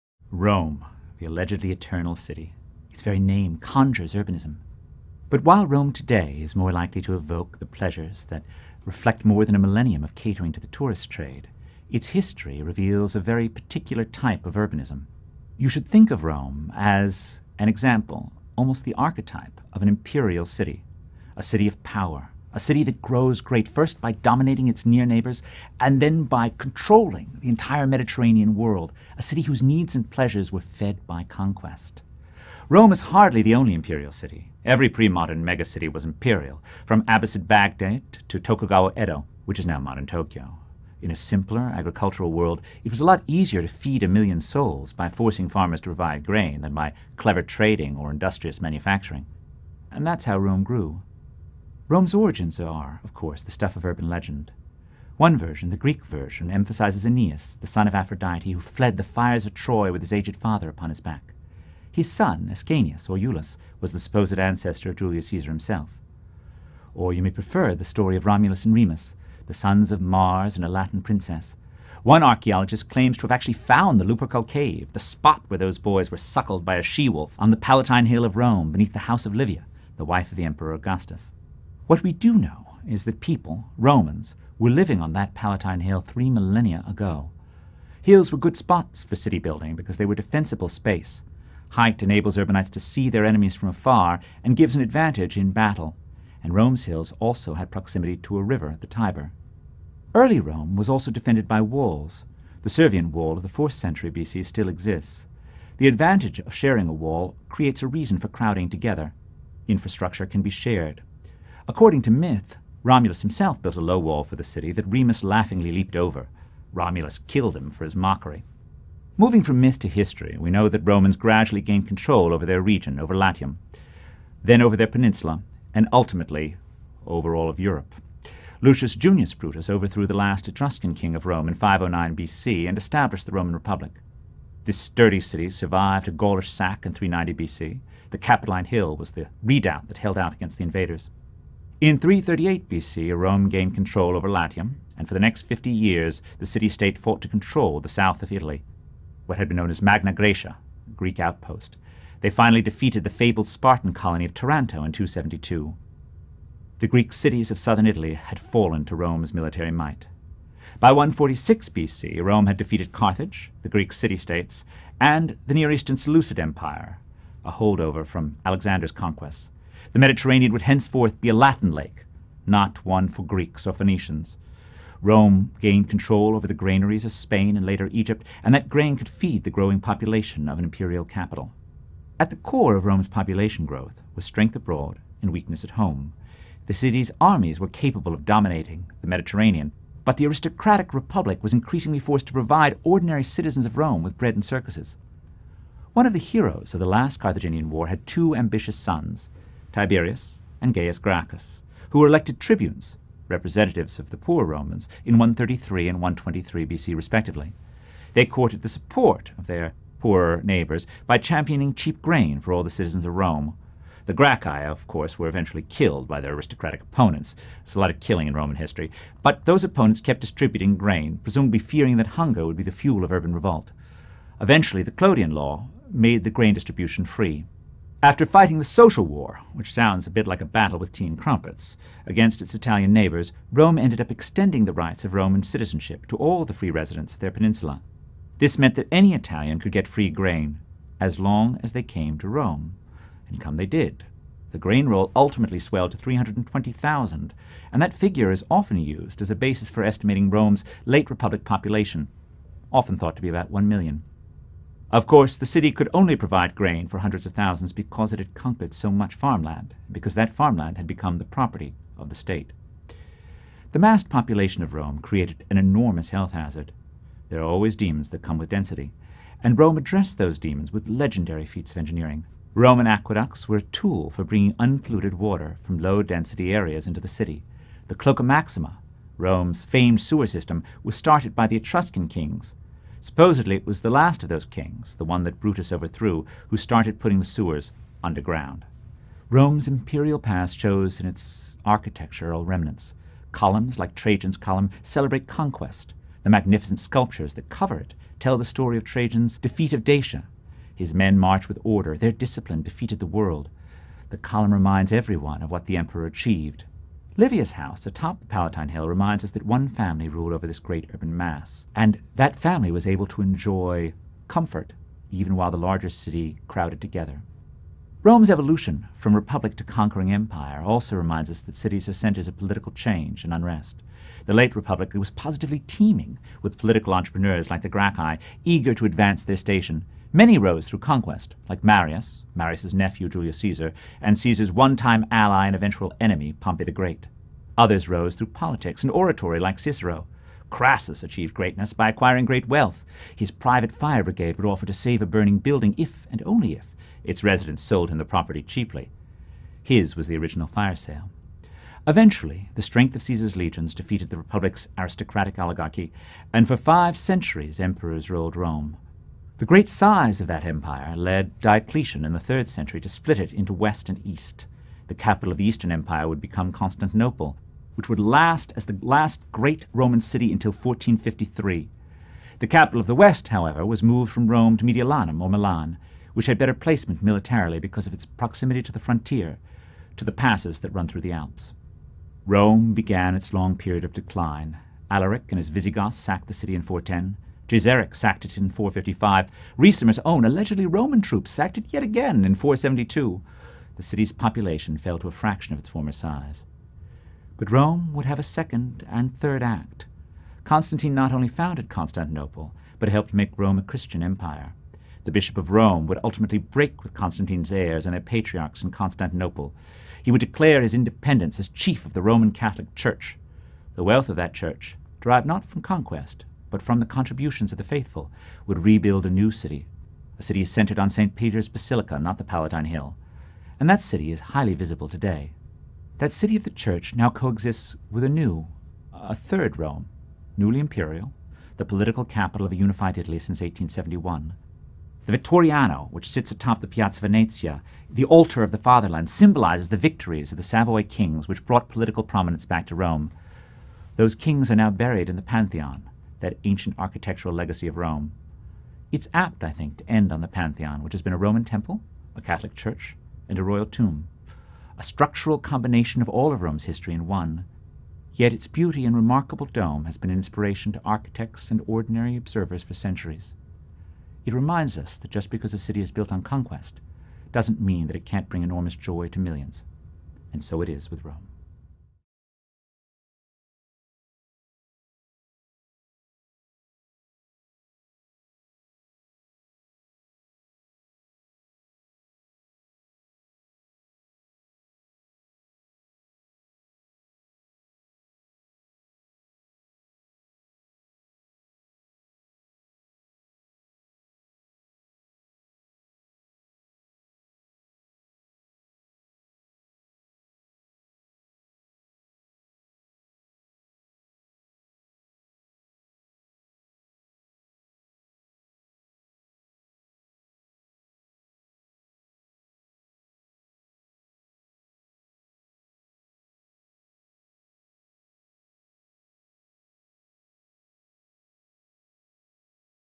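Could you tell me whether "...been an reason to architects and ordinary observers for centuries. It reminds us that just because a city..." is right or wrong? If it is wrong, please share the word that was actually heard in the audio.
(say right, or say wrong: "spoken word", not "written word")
wrong: "inspiration", not "reason".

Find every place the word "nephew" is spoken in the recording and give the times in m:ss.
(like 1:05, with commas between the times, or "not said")
5:32.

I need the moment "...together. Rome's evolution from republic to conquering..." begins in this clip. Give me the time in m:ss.
5:16.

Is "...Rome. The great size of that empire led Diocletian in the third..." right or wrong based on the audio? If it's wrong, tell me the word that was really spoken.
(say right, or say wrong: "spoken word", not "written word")
right.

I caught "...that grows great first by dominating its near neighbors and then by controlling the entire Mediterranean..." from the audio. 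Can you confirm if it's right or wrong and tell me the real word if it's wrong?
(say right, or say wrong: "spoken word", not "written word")
right.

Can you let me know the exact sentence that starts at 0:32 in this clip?
Rome is hardly the only imperial city.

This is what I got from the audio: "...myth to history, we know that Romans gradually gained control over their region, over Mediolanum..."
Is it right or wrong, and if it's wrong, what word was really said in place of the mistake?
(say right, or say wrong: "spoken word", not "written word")
wrong: "Latium", not "Mediolanum".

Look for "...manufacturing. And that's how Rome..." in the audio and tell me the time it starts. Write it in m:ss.
0:48.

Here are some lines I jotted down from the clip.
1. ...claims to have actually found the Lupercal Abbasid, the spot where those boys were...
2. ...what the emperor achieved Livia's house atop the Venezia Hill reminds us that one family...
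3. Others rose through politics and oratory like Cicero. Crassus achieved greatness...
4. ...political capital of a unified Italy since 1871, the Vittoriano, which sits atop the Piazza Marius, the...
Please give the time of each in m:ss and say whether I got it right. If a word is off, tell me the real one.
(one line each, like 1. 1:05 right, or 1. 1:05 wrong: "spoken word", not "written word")
1. 1:12 wrong: "Cave", not "Abbasid"
2. 5:05 wrong: "Palatine", not "Venezia"
3. 5:37 right
4. 7:11 wrong: "Venezia", not "Marius".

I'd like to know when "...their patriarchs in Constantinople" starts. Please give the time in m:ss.
6:47.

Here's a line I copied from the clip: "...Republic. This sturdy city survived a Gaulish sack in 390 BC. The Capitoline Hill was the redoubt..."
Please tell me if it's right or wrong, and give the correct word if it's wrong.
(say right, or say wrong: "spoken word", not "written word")
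right.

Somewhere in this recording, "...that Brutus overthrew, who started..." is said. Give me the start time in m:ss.
4:45.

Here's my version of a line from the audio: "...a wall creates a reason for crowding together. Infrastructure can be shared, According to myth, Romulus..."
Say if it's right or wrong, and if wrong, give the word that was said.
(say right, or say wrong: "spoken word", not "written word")
right.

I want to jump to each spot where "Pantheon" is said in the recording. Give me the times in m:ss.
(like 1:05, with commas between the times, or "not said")
7:25, 7:30.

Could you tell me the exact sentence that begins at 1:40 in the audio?
Early Rome was also defended by walls.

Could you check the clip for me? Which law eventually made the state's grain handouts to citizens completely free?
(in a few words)
the Clodian law.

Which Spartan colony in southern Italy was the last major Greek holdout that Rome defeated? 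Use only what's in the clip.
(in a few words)
Taranto.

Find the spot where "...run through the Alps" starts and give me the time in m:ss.
6:20.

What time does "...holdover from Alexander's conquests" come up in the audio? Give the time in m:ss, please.
2:47.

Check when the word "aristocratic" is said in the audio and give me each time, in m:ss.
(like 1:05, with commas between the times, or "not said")
3:10, 3:36, 5:54.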